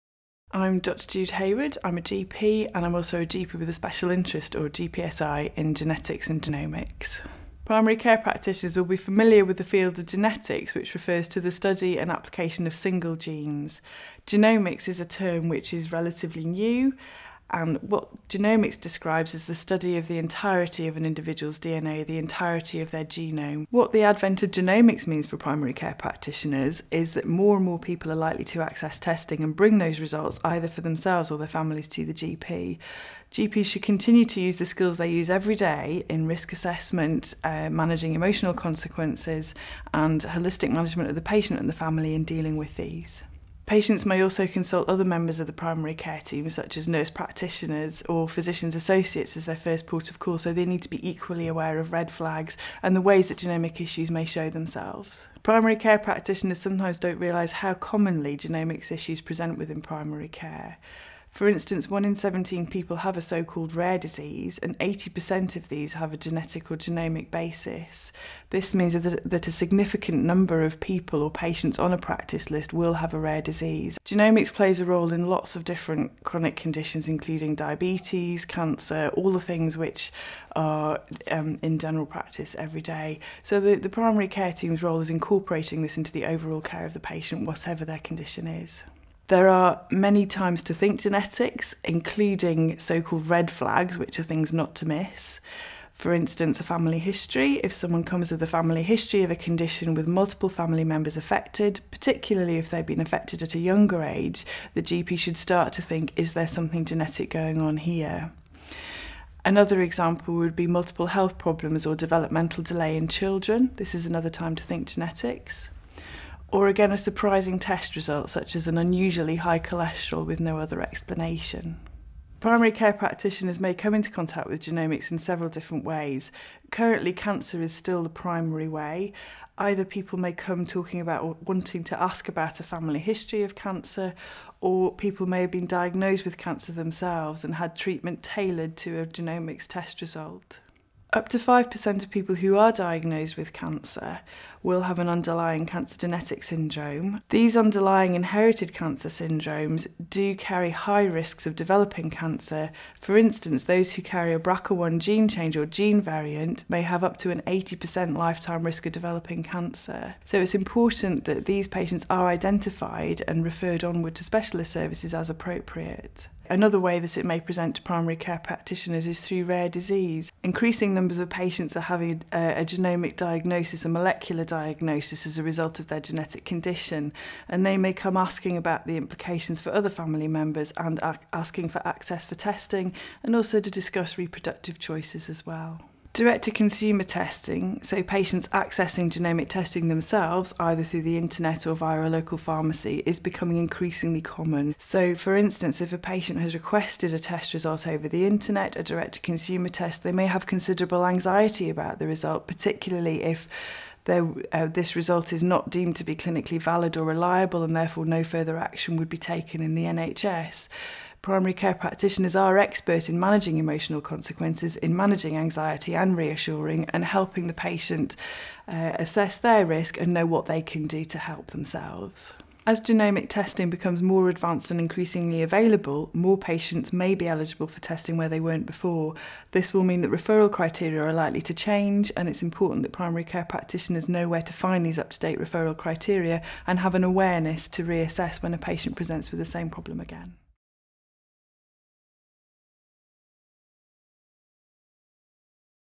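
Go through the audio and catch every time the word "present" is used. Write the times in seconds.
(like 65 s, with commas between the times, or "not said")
59 s, 167 s, 238 s.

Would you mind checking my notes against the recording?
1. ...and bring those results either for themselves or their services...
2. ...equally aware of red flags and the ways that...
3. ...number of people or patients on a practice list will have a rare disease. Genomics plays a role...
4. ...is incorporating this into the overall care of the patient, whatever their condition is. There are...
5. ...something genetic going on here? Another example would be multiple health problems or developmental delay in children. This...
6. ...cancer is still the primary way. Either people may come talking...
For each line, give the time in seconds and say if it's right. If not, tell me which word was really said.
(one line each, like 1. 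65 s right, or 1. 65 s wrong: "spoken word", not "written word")
1. 29 s wrong: "families", not "services"
2. 51 s right
3. 70 s right
4. 84 s right
5. 106 s right
6. 127 s right.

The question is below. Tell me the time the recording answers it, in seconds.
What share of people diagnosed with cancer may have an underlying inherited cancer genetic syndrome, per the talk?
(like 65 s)
141 s.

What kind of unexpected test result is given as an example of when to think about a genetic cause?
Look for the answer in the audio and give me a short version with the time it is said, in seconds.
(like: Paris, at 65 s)
Unusually high cholesterol, at 118 s.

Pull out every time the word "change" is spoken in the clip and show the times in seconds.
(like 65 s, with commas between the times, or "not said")
155 s, 231 s.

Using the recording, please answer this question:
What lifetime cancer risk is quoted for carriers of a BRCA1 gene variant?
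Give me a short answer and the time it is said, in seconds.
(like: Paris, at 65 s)
Up to 80%, at 157 s.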